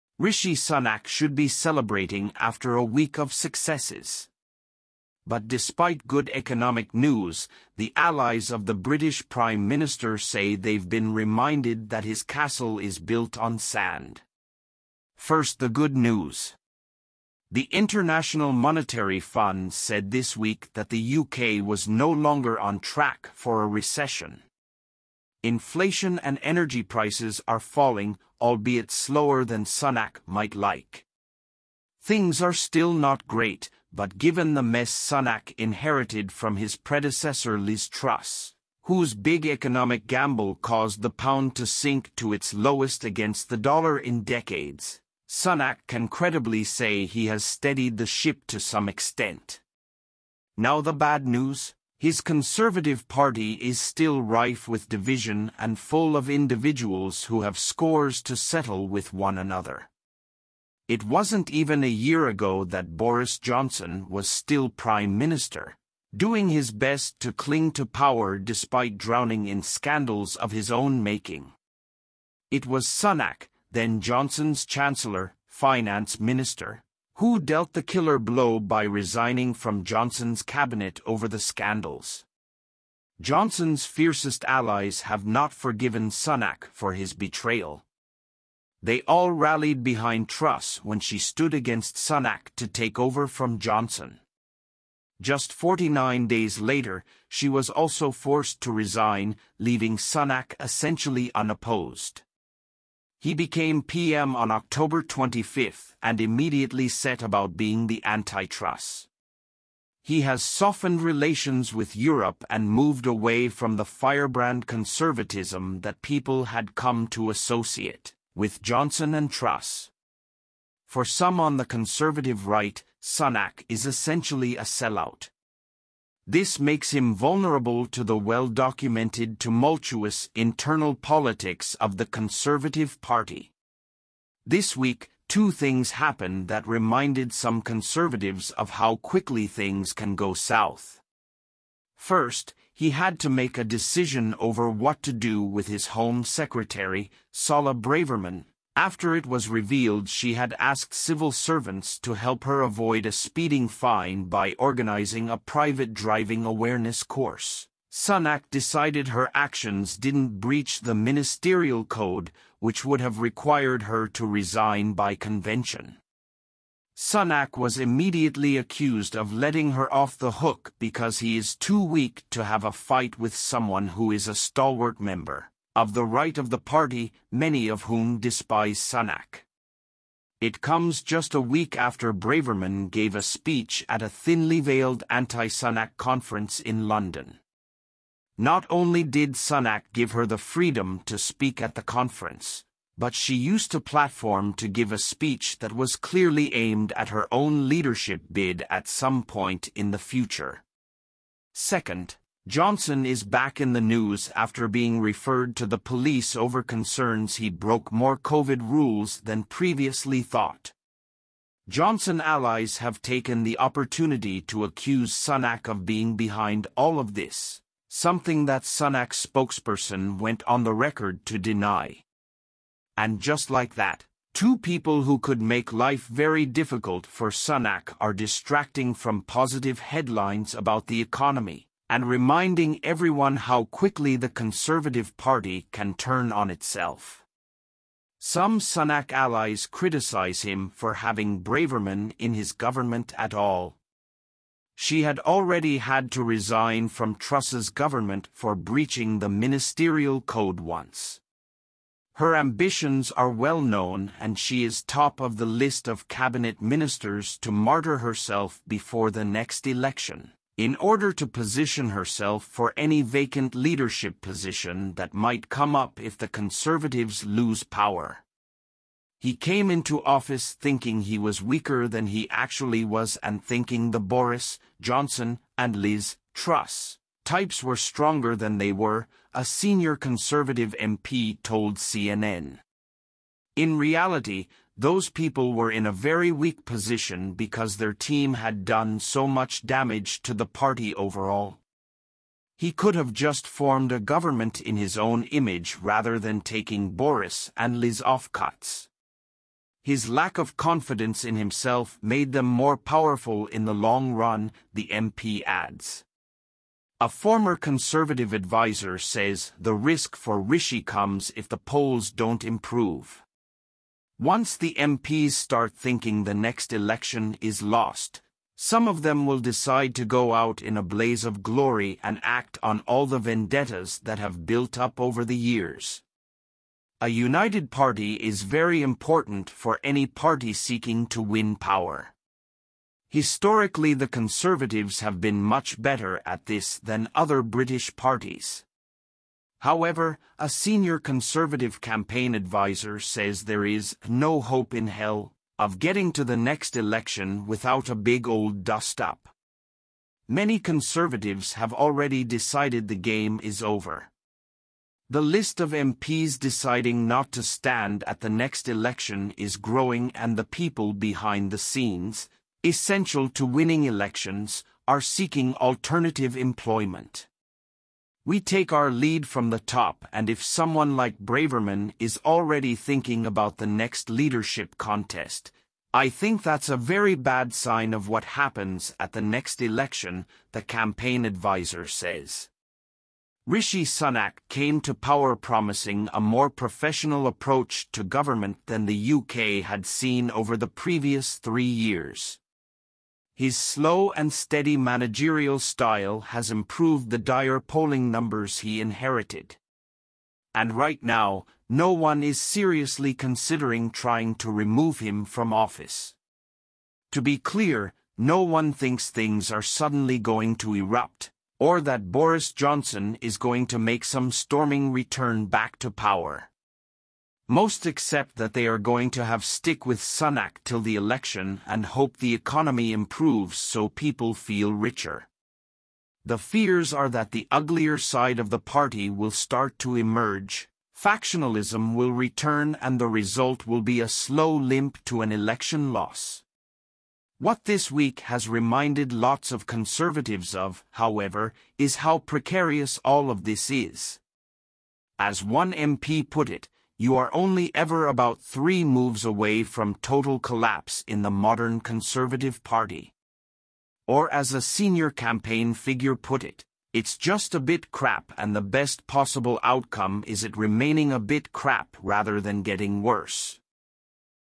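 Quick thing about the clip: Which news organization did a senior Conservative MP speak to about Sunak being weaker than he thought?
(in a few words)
CNN.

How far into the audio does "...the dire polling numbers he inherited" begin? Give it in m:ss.
6:37.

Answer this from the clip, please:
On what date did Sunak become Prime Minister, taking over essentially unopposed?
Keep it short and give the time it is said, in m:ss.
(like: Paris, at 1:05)
October 25, at 1:44.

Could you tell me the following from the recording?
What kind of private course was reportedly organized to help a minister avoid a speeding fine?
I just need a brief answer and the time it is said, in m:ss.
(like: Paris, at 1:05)
driving awareness course, at 2:35.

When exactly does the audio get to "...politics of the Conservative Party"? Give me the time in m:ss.
2:10.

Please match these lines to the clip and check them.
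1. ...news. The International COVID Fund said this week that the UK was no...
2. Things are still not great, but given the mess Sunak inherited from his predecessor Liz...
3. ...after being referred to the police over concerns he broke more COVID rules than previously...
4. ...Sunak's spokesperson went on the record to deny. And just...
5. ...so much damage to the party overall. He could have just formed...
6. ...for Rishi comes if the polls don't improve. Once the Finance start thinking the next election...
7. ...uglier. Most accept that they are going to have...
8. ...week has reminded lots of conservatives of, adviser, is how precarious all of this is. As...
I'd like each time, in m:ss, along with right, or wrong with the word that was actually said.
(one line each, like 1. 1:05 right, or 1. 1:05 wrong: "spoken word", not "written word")
1. 0:15 wrong: "Monetary", not "COVID"
2. 0:32 right
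3. 3:24 right
4. 3:38 right
5. 4:48 right
6. 5:10 wrong: "MPs", not "Finance"
7. 6:55 wrong: "power", not "uglier"
8. 7:17 wrong: "however", not "adviser".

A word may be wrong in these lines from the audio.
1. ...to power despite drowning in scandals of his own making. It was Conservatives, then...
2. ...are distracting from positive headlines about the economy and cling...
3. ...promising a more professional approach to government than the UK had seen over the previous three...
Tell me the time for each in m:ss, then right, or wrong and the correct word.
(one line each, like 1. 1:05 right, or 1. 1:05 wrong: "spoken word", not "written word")
1. 1:07 wrong: "Sunak", not "Conservatives"
2. 3:48 wrong: "reminding", not "cling"
3. 6:25 right.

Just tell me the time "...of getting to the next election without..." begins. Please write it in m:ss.
5:45.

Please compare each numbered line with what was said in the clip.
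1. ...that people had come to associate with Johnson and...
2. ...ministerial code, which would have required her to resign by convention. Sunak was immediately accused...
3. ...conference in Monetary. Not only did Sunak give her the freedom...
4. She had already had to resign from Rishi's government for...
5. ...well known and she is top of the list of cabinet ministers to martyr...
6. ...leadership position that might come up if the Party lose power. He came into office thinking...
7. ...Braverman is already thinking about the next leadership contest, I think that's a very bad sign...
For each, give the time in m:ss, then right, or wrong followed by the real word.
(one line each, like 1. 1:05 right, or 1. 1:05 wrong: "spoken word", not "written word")
1. 1:55 right
2. 2:40 right
3. 3:05 wrong: "London", not "Monetary"
4. 4:04 wrong: "Truss", not "Rishi"
5. 4:13 right
6. 4:23 wrong: "Conservatives", not "Party"
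7. 6:11 right.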